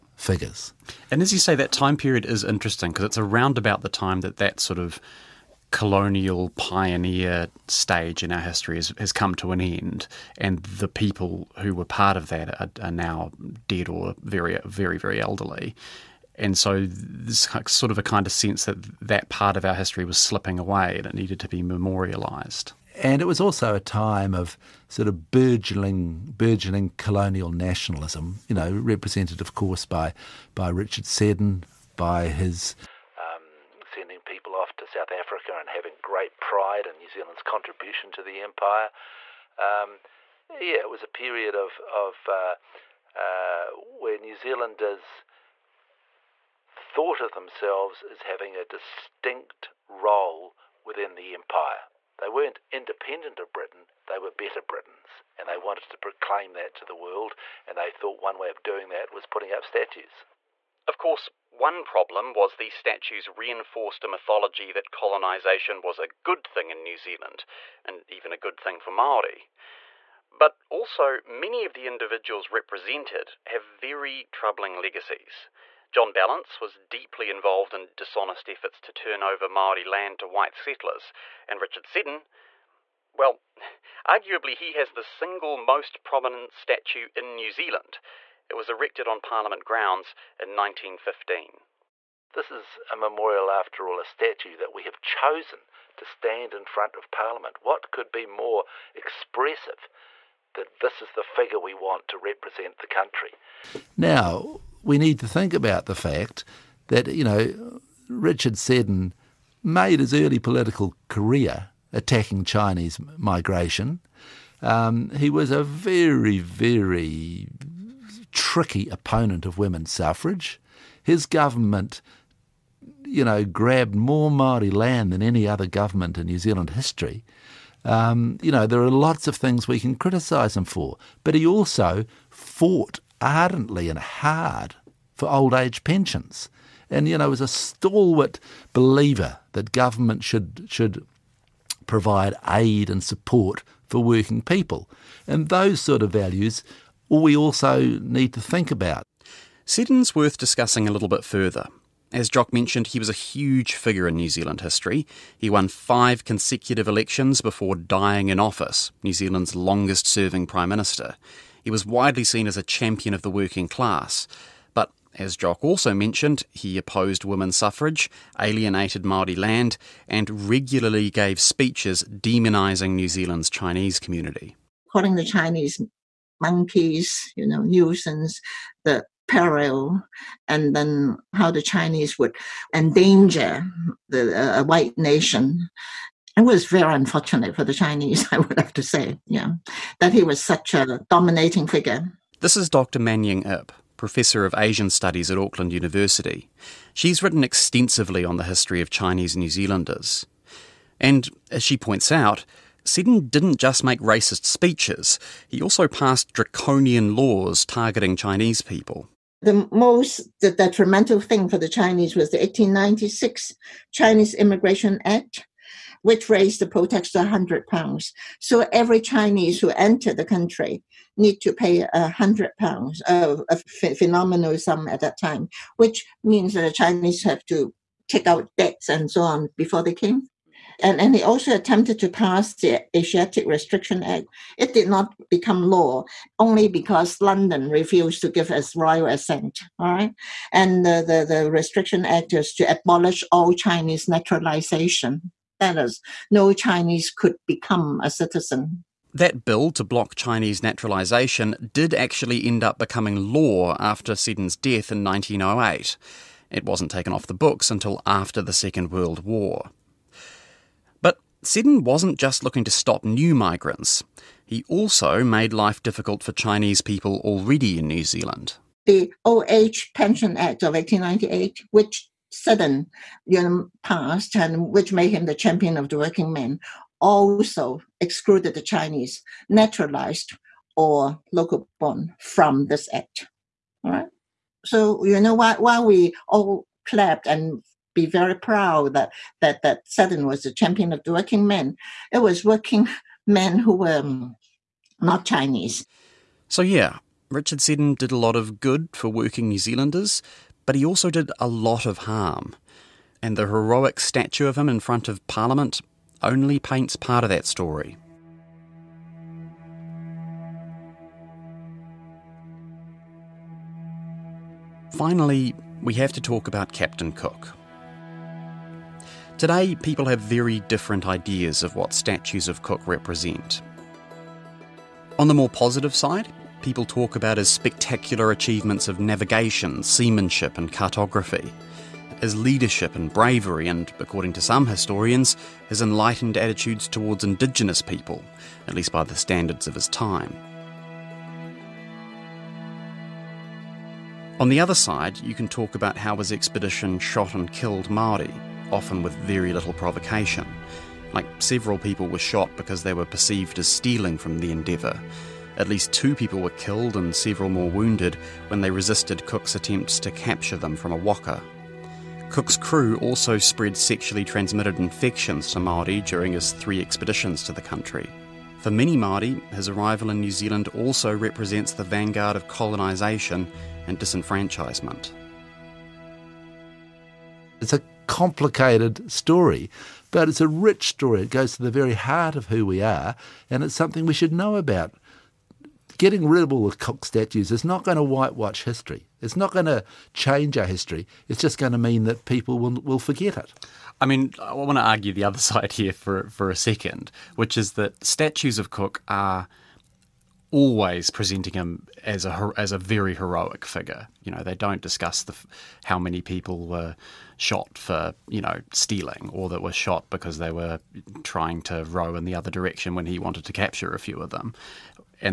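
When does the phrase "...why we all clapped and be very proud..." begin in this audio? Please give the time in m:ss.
4:45.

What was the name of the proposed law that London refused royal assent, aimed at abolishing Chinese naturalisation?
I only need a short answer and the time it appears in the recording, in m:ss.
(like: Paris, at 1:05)
Asiatic Restriction Act, at 3:52.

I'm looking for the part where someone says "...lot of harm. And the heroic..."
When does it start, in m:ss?
5:01.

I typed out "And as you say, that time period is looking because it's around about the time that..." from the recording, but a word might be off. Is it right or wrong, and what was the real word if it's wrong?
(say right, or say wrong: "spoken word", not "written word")
wrong: "interesting", not "looking".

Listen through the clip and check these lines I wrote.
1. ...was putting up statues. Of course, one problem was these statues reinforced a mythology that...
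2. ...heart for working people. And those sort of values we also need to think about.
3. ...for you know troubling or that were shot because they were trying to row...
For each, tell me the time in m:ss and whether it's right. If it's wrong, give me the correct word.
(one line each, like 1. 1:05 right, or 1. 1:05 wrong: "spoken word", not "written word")
1. 0:59 right
2. 2:23 wrong: "support", not "heart"
3. 6:47 wrong: "stealing", not "troubling".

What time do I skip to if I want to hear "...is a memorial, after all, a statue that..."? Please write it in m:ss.
1:32.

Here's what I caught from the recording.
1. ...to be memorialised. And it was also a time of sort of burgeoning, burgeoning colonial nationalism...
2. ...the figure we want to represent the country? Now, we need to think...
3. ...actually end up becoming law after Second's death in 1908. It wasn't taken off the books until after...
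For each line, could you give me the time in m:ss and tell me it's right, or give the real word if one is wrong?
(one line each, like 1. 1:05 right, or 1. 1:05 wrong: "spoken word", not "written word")
1. 0:21 right
2. 1:41 right
3. 4:11 wrong: "Seddon", not "Second".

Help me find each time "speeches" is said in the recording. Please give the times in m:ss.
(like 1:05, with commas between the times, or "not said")
2:51, 3:24.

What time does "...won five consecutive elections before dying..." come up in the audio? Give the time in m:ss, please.
2:35.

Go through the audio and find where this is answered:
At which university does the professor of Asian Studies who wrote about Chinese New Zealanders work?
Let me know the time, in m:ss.
3:15.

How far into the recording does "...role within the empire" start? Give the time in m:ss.
0:49.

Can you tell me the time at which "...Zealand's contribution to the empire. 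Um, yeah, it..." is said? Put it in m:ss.
0:37.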